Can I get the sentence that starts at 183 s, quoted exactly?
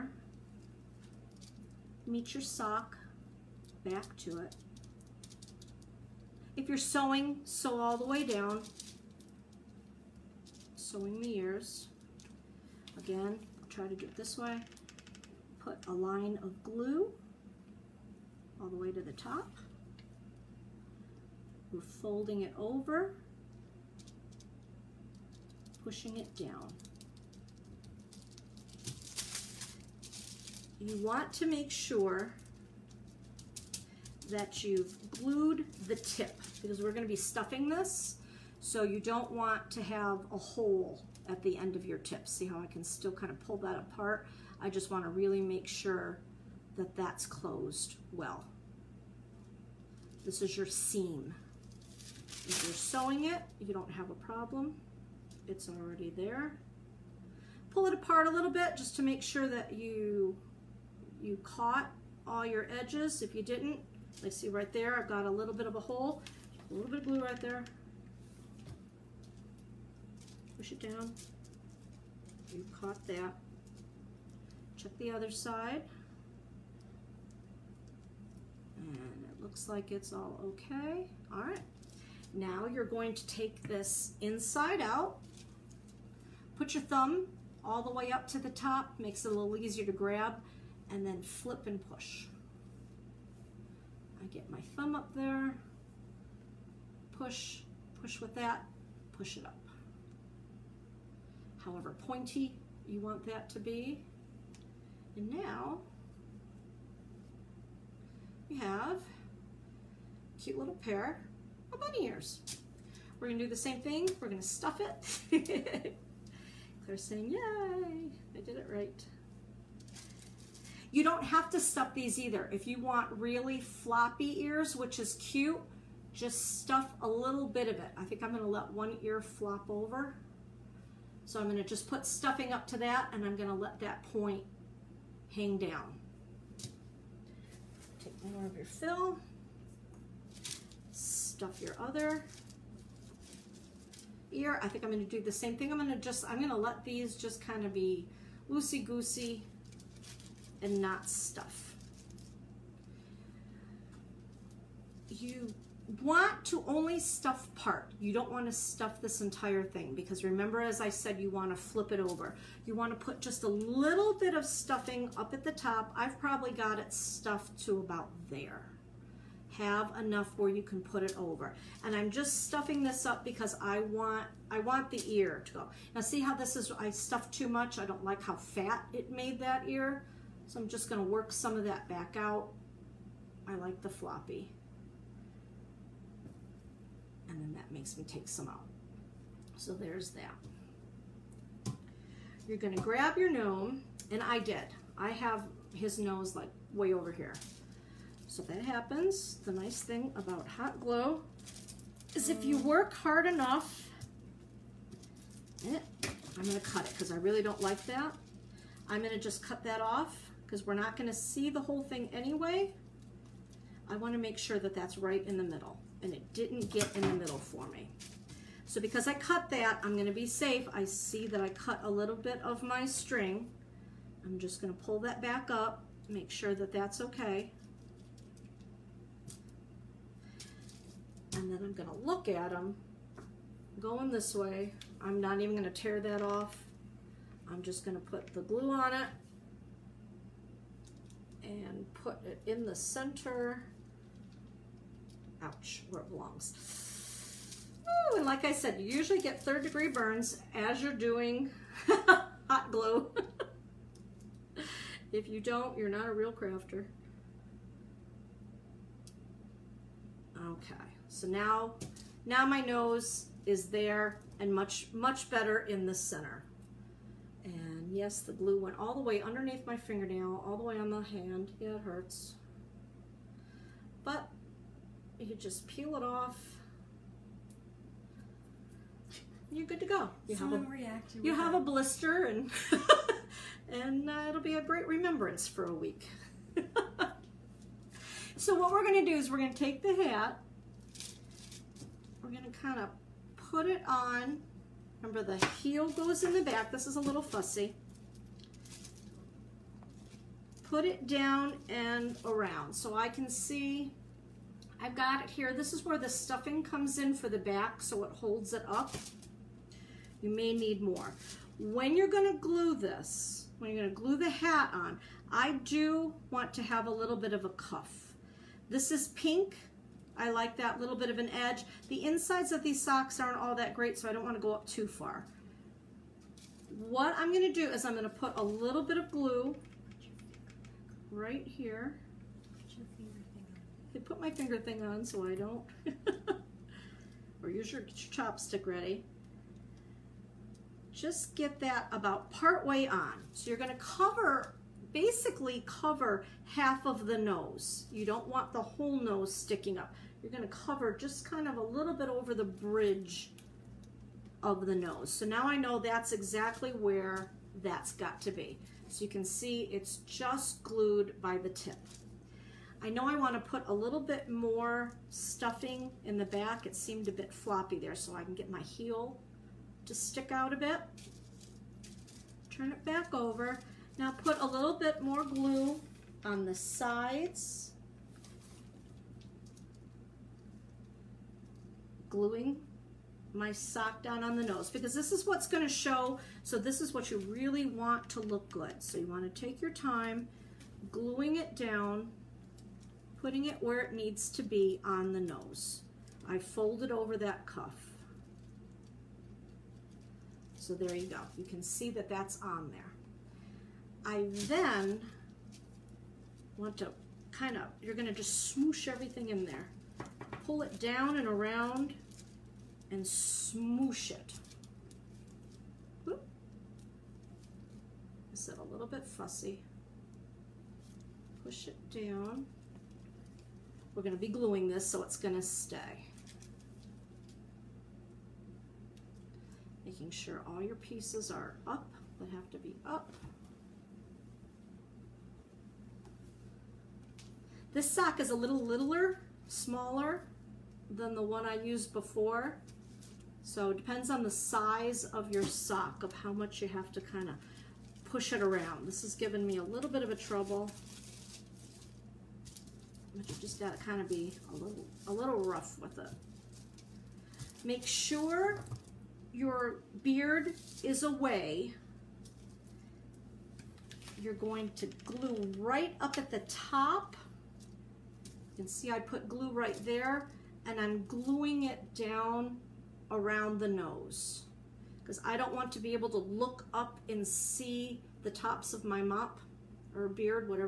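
I like the floppy and then that makes me take some out.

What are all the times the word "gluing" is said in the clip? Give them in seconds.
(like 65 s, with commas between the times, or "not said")
382 s, 390 s, 424 s, 471 s.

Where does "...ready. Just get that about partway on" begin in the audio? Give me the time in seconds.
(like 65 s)
338 s.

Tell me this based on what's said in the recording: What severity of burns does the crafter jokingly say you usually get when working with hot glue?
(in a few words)
third degree.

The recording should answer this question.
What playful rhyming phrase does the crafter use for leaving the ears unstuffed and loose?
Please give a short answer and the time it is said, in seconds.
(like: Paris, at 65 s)
loosey-goosey, at 148 s.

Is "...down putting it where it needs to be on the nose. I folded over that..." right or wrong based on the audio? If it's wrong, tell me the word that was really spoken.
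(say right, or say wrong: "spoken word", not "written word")
right.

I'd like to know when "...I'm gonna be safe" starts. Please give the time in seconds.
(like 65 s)
219 s.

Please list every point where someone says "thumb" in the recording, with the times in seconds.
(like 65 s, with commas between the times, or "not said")
86 s, 94 s.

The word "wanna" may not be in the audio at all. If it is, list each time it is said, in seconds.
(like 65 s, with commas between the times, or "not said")
213 s, 324 s.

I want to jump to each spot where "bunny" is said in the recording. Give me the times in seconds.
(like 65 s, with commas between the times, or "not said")
111 s.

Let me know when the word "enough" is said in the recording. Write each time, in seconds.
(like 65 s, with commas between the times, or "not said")
169 s, 203 s.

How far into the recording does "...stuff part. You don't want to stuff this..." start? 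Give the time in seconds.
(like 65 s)
156 s.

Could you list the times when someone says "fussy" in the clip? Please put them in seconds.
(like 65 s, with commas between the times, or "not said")
297 s, 419 s.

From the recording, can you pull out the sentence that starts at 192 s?
You're gonna grab your gnome, and I did.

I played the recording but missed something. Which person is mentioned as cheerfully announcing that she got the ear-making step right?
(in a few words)
Claire.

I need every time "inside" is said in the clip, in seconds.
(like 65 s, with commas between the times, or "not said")
84 s, 322 s.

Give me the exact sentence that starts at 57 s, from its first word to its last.
Pull it apart a little bit just to make sure that you, you caught all your edges.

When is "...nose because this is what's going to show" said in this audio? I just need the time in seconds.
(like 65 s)
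384 s.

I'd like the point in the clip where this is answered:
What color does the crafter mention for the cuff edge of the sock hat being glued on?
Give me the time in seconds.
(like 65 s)
319 s.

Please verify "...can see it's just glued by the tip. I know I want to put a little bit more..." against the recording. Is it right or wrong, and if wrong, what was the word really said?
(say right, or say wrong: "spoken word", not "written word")
right.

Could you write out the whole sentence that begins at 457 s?
Make sure your beard is away.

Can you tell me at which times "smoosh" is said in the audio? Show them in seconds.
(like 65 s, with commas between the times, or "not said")
408 s, 413 s.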